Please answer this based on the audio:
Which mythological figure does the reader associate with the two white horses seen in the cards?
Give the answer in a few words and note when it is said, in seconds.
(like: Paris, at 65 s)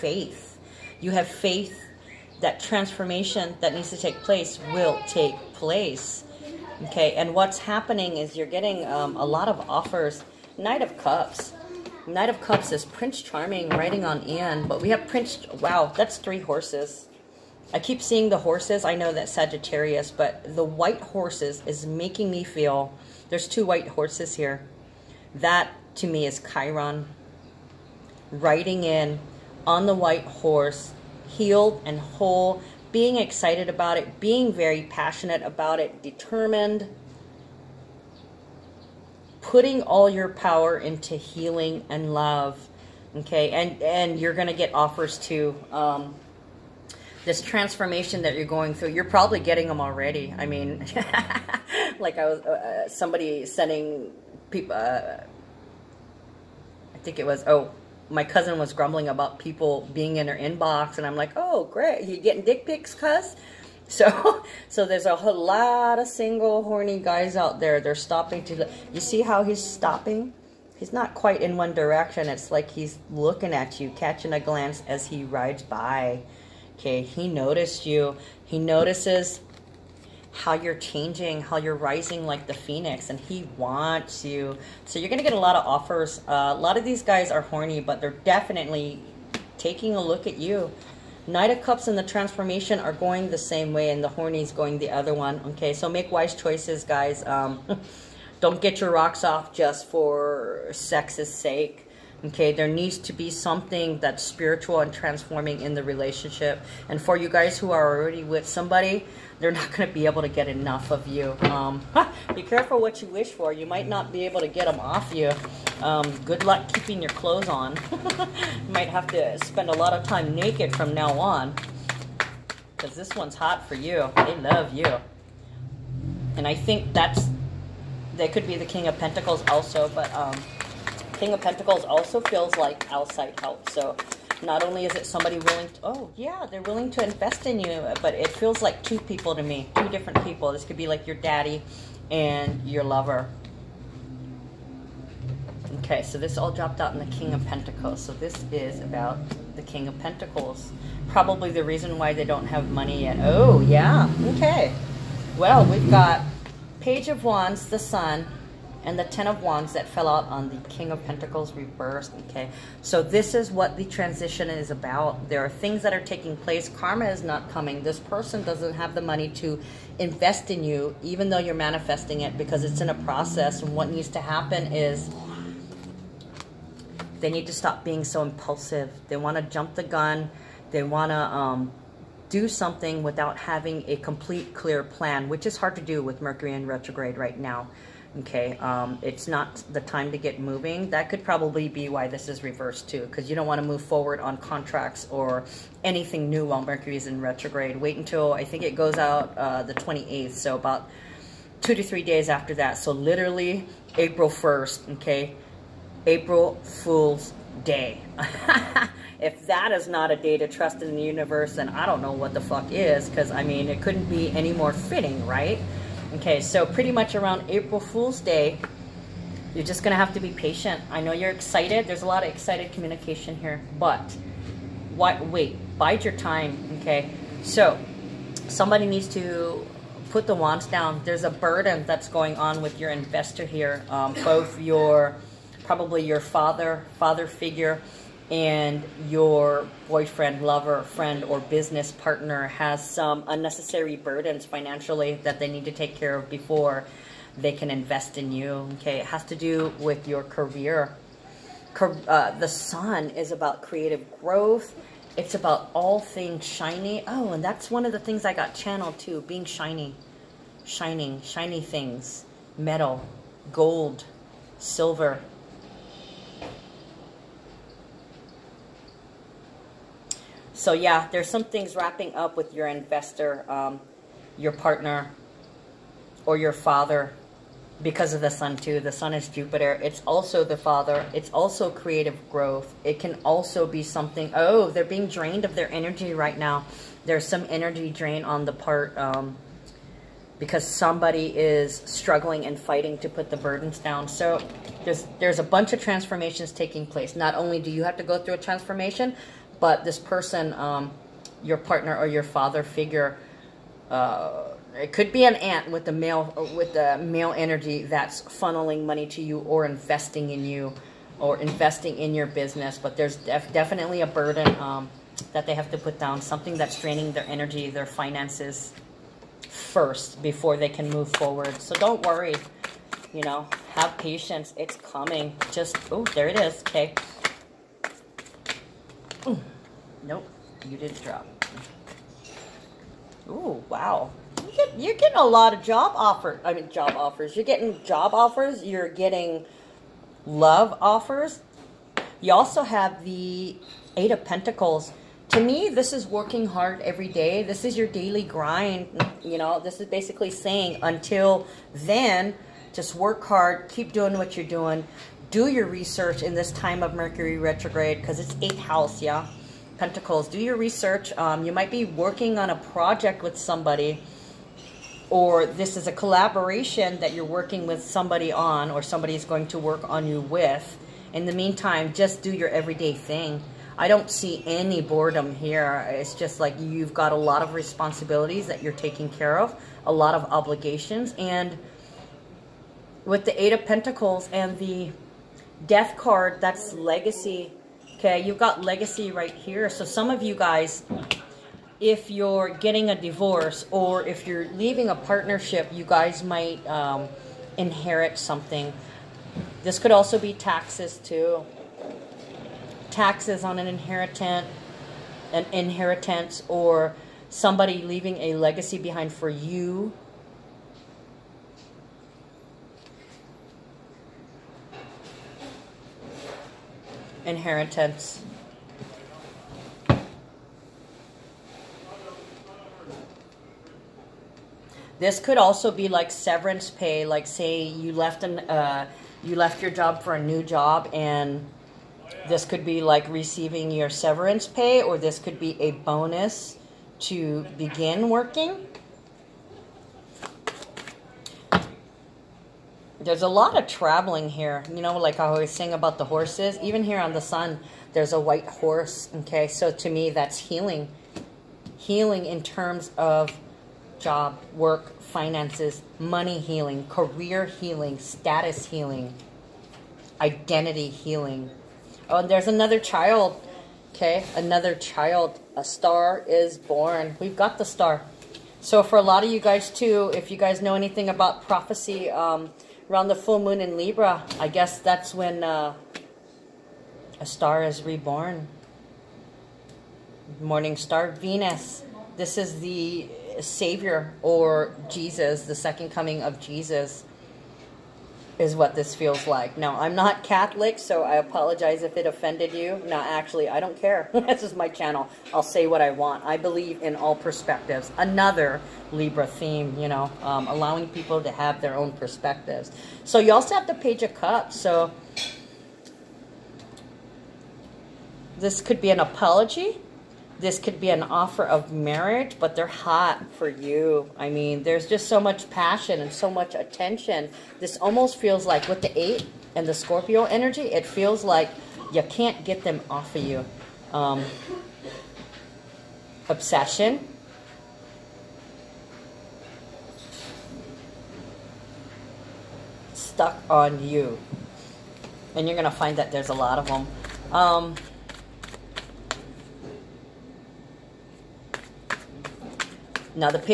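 Chiron, at 26 s.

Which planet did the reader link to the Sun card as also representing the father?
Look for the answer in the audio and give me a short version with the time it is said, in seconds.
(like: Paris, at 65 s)
Jupiter, at 279 s.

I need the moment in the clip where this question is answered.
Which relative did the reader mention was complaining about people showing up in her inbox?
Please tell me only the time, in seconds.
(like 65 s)
58 s.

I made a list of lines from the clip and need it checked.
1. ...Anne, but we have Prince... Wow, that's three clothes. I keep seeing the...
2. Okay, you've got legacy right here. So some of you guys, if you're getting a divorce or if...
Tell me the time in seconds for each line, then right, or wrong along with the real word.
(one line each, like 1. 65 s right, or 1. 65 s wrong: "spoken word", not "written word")
1. 14 s wrong: "horses", not "clothes"
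2. 387 s right.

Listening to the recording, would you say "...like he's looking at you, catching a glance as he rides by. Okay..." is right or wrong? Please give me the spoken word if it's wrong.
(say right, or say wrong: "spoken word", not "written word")
right.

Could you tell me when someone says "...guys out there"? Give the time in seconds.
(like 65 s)
66 s.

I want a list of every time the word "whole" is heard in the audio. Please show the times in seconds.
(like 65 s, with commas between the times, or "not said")
31 s, 65 s.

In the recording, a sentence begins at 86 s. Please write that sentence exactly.
Uh, a lot of these guys are horny, but they're definitely taking a look at you.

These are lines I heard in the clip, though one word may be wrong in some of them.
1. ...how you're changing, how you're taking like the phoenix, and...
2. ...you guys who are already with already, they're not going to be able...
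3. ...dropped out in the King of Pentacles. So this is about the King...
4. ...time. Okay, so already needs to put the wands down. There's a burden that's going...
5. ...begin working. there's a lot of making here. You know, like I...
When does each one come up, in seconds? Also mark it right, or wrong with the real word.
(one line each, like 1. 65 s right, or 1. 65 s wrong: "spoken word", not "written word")
1. 80 s wrong: "rising", not "taking"
2. 107 s wrong: "somebody", not "already"
3. 146 s right
4. 226 s wrong: "somebody", not "already"
5. 437 s wrong: "traveling", not "making".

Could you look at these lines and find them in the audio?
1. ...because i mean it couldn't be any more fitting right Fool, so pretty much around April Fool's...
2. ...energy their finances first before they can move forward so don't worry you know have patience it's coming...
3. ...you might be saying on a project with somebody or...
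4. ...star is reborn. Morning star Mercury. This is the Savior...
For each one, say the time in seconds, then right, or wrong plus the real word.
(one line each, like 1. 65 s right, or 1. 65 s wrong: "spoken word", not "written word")
1. 213 s wrong: "Okay", not "Fool"
2. 317 s right
3. 361 s wrong: "working", not "saying"
4. 477 s wrong: "Venus", not "Mercury".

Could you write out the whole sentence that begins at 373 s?
I don't see any boredom here.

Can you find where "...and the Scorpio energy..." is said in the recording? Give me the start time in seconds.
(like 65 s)
519 s.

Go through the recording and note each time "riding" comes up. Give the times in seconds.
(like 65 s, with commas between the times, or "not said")
13 s, 28 s.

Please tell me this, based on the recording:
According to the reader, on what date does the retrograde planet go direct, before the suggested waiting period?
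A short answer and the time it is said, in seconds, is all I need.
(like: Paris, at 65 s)
28th, at 199 s.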